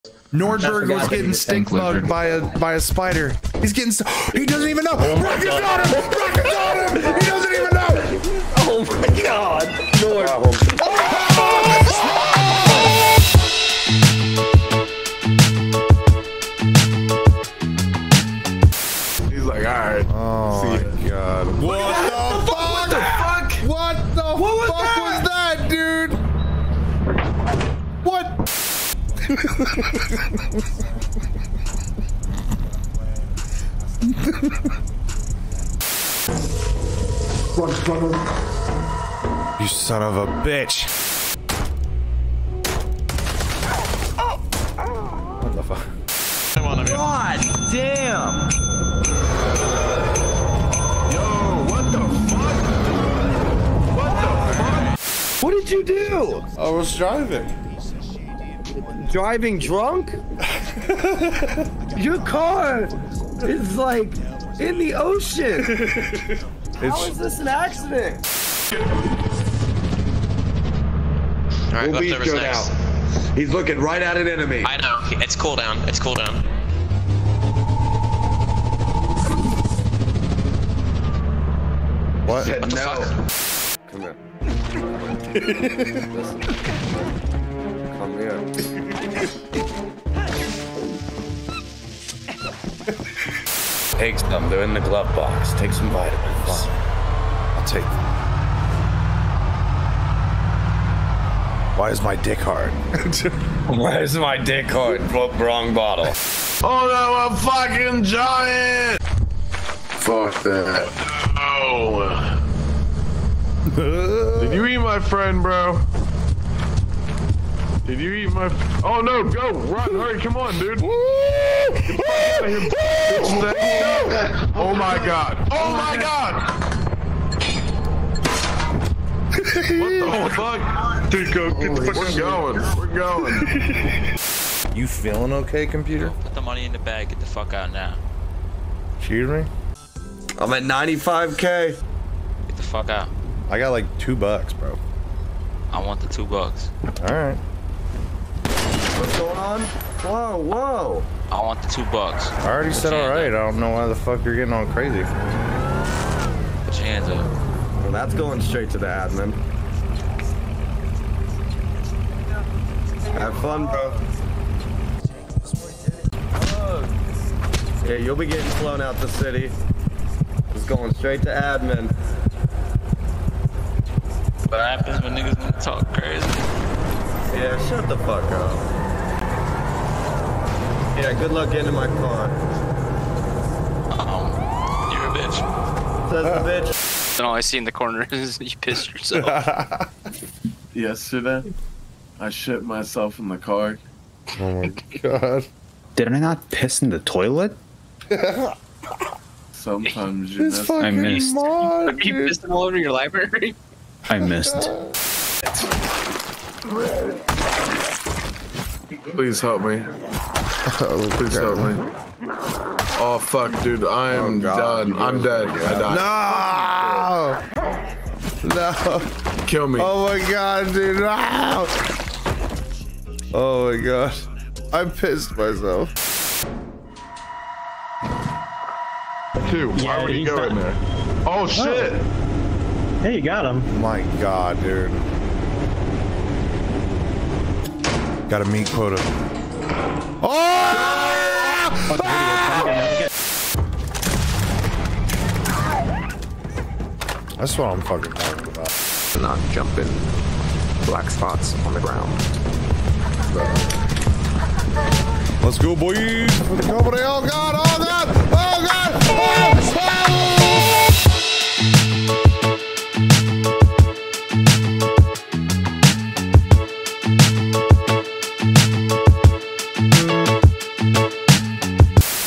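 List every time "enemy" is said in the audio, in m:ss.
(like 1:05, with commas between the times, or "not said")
1:14.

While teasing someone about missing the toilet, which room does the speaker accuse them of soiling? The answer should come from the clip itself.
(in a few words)
library.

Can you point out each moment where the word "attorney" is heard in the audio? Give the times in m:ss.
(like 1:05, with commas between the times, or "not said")
not said.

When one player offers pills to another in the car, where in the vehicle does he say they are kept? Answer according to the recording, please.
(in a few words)
glove box.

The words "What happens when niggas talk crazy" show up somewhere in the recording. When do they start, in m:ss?
2:54.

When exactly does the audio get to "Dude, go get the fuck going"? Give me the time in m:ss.
2:11.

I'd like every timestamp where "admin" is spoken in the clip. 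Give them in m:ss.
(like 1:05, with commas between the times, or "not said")
2:38, 2:51.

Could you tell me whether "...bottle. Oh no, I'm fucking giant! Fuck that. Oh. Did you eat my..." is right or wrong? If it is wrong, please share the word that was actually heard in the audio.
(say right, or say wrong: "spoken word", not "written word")
right.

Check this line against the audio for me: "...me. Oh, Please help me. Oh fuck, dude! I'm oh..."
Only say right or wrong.
right.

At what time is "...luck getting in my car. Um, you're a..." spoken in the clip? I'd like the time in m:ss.
3:01.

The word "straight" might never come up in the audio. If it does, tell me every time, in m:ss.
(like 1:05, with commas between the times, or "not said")
2:38, 2:50.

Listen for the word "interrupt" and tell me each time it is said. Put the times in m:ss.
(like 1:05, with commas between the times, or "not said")
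not said.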